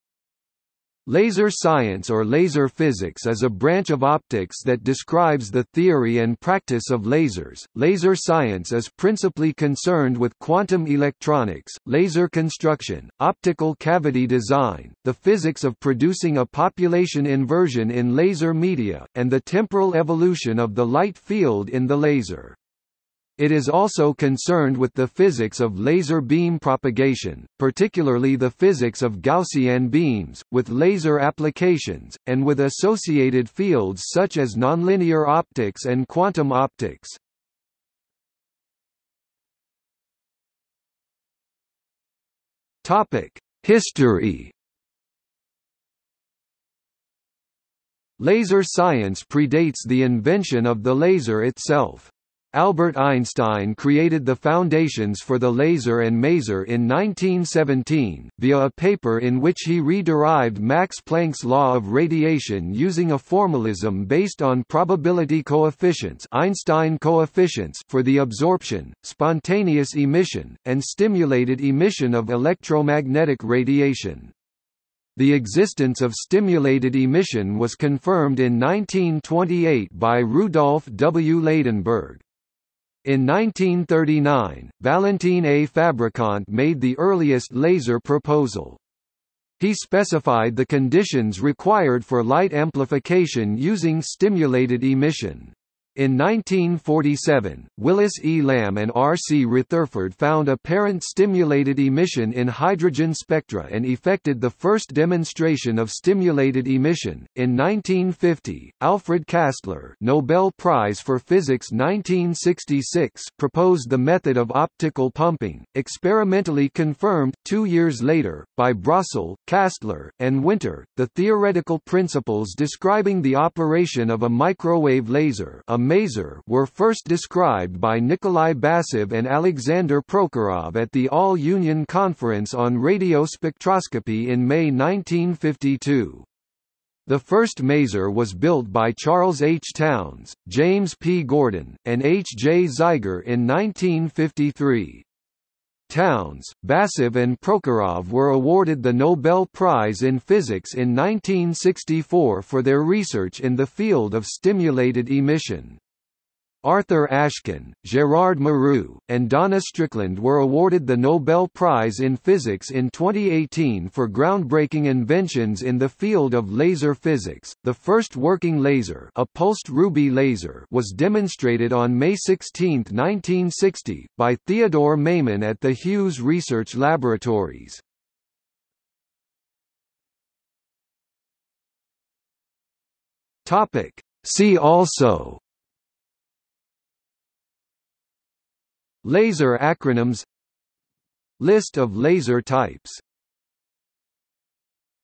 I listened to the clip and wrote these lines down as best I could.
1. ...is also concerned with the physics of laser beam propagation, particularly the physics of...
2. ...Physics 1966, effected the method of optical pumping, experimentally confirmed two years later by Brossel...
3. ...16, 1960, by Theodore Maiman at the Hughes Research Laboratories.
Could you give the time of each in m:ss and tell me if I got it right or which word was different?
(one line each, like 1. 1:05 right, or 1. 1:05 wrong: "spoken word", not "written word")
1. 0:23 right
2. 1:51 wrong: "proposed", not "effected"
3. 2:52 right.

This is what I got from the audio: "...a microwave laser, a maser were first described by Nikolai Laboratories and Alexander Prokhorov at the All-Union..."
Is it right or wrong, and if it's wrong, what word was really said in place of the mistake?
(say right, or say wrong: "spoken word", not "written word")
wrong: "Basov", not "Laboratories".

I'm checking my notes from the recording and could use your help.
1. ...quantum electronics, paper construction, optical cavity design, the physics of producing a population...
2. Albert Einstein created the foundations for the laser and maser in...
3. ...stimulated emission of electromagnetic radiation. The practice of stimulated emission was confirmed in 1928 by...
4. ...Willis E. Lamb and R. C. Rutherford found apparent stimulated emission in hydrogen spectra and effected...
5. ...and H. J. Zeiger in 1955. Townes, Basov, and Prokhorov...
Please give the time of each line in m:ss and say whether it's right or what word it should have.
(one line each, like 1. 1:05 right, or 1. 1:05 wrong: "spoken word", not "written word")
1. 0:10 wrong: "laser", not "paper"
2. 0:52 right
3. 1:10 wrong: "existence", not "practice"
4. 1:37 right
5. 2:21 wrong: "1953", not "1955".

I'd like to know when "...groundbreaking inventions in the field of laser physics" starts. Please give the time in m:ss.
2:44.